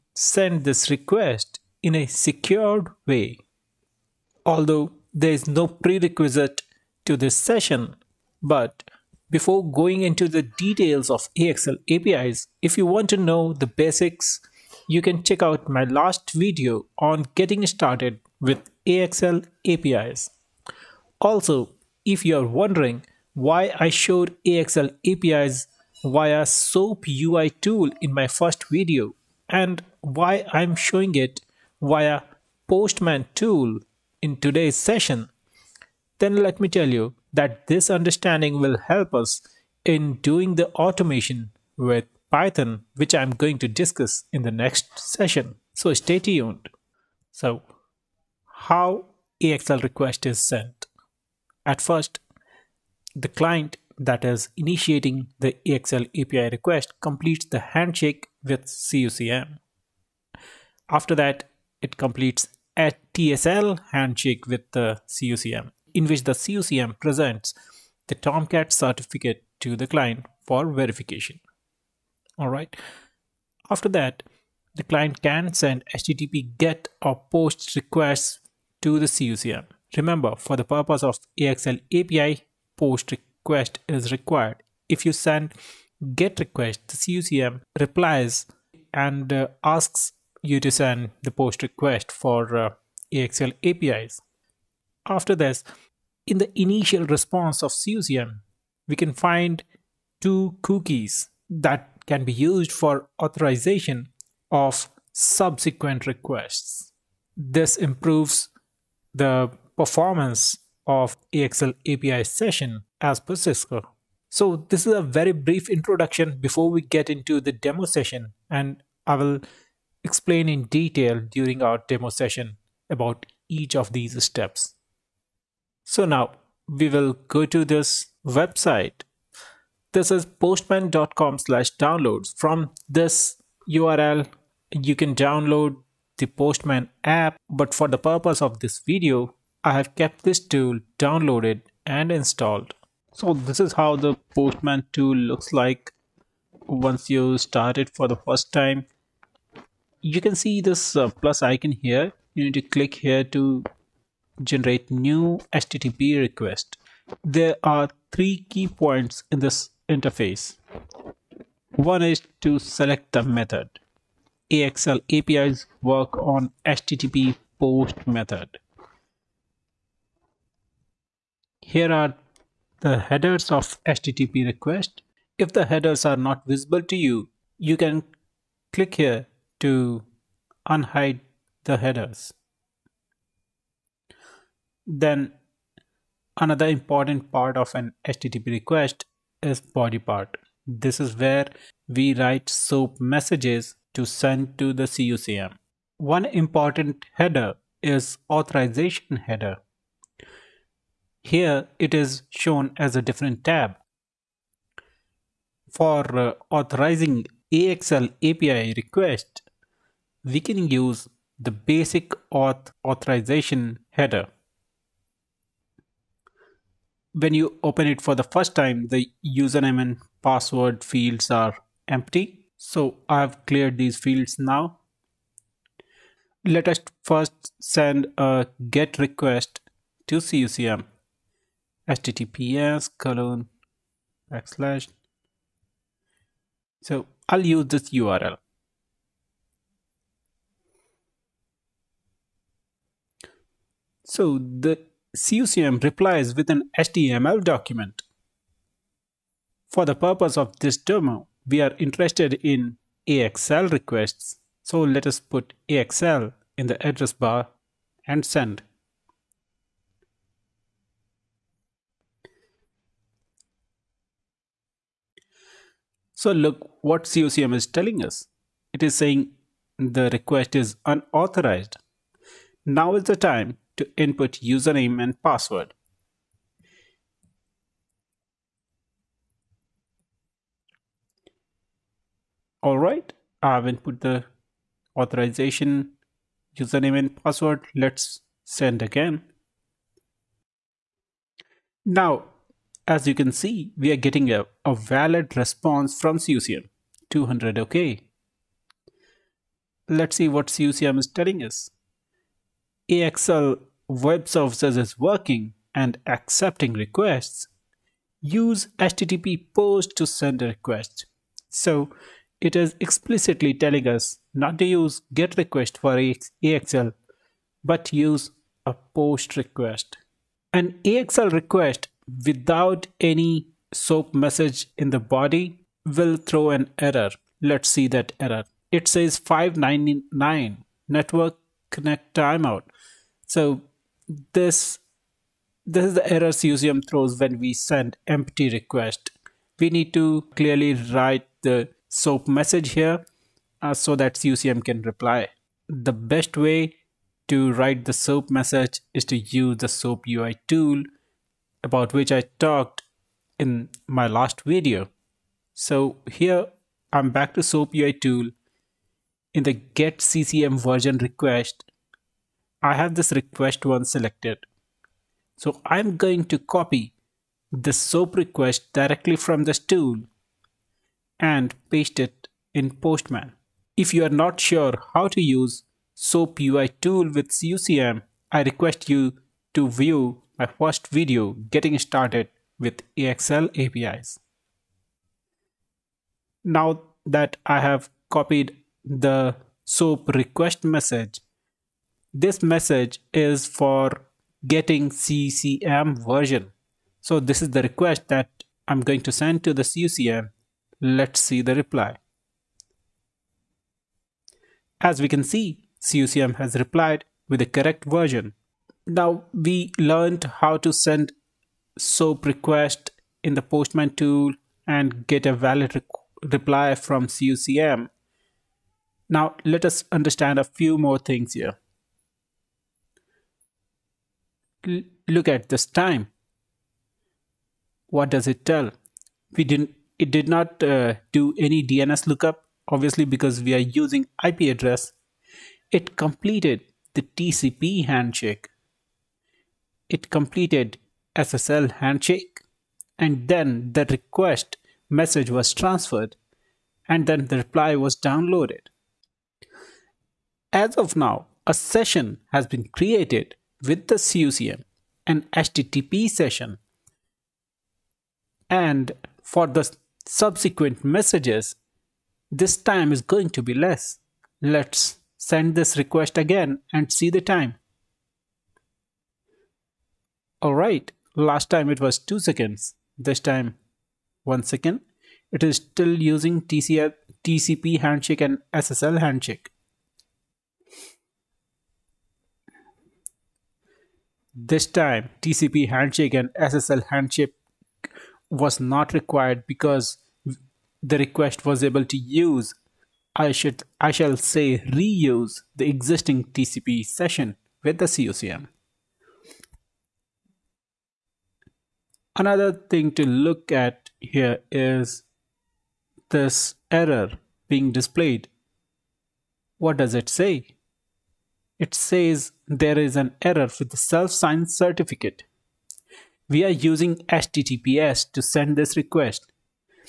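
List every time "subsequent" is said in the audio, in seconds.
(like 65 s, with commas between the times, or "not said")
105 s, 460 s.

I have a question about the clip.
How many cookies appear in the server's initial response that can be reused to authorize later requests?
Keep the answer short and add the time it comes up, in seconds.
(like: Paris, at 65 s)
2, at 100 s.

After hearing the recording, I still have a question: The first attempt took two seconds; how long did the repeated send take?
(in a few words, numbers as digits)
1 second.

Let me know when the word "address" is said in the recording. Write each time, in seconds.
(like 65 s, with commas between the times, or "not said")
256 s, 434 s.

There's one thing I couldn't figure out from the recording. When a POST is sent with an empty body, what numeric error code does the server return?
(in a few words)
599.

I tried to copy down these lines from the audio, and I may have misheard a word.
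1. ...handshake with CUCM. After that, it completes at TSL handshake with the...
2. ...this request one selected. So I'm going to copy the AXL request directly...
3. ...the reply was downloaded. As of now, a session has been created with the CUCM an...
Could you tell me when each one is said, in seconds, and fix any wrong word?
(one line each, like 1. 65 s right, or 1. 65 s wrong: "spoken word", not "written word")
1. 57 s right
2. 362 s wrong: "SOAP", not "AXL"
3. 447 s right.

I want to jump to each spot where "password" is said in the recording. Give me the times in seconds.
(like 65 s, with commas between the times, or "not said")
220 s, 275 s, 287 s.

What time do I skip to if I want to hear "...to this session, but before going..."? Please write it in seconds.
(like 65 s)
7 s.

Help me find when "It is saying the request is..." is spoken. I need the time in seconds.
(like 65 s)
268 s.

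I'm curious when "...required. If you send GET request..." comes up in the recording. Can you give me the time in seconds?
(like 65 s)
84 s.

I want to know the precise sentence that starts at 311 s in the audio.
So it is explicitly telling us not to use get request for AXL, but use a post request.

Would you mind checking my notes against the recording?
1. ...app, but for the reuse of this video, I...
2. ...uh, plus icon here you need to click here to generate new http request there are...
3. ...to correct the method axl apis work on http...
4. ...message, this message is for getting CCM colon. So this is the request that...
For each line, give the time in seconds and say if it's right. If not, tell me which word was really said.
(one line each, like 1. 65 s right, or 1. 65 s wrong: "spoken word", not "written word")
1. 137 s wrong: "purpose", not "reuse"
2. 150 s right
3. 162 s wrong: "select", not "correct"
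4. 390 s wrong: "version", not "colon".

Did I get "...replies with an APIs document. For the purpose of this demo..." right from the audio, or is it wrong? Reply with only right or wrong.
wrong.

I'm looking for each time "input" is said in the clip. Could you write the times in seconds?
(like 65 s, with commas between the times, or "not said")
273 s, 283 s.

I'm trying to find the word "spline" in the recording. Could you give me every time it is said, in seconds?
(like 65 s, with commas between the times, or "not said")
not said.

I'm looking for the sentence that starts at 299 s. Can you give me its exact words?
Let's see what CUCM is telling us.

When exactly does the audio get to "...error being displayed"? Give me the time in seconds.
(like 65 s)
506 s.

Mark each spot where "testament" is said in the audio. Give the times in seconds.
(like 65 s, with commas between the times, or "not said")
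not said.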